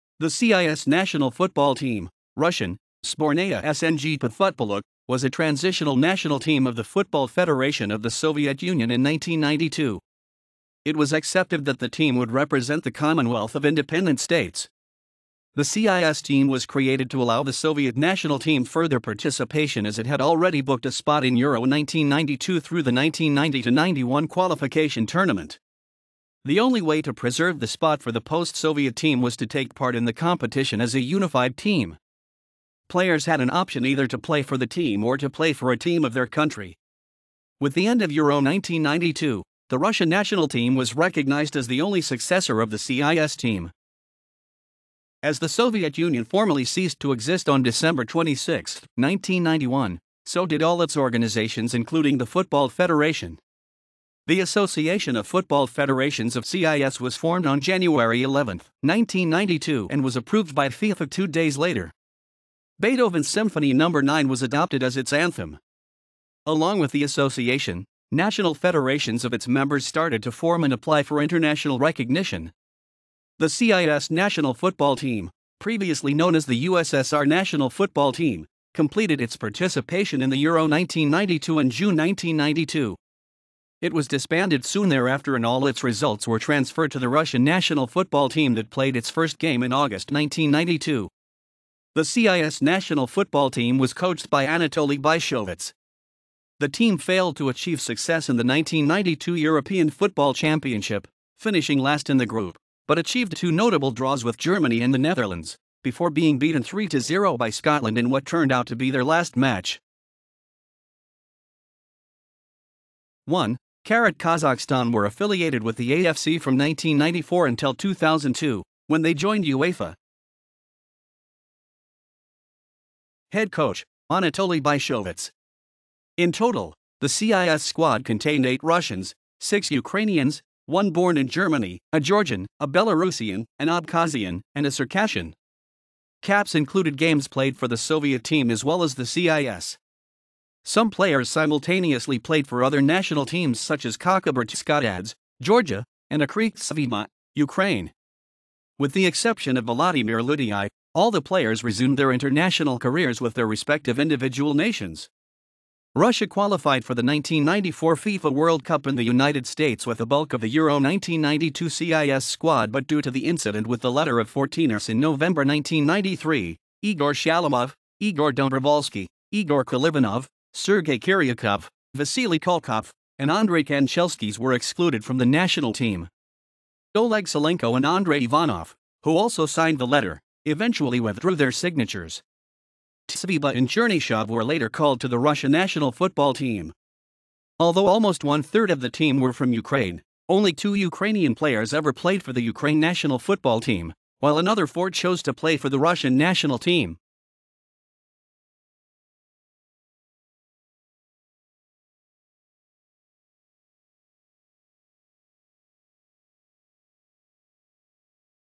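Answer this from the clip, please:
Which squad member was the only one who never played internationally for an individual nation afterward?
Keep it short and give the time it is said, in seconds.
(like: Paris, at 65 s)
Volodymyr Lyutyi, at 149 s.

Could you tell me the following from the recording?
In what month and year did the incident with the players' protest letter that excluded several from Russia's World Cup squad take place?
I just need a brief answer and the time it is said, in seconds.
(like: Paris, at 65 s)
November 1993, at 164 s.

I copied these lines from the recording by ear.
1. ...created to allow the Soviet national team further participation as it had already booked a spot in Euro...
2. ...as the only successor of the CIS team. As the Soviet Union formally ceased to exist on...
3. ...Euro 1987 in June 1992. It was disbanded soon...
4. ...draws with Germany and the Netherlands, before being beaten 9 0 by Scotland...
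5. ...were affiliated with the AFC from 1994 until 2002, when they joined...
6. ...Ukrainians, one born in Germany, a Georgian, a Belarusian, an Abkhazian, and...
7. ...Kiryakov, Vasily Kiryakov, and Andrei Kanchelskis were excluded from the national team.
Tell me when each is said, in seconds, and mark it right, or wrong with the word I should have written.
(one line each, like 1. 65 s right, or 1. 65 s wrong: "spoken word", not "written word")
1. 16 s right
2. 41 s right
3. 80 s wrong: "1992", not "1987"
4. 103 s wrong: "3", not "9"
5. 114 s right
6. 129 s right
7. 170 s wrong: "Kulkov", not "Kiryakov".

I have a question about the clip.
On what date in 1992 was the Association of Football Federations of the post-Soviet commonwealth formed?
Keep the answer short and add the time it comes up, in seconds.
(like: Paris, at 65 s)
January 11, 1992, at 57 s.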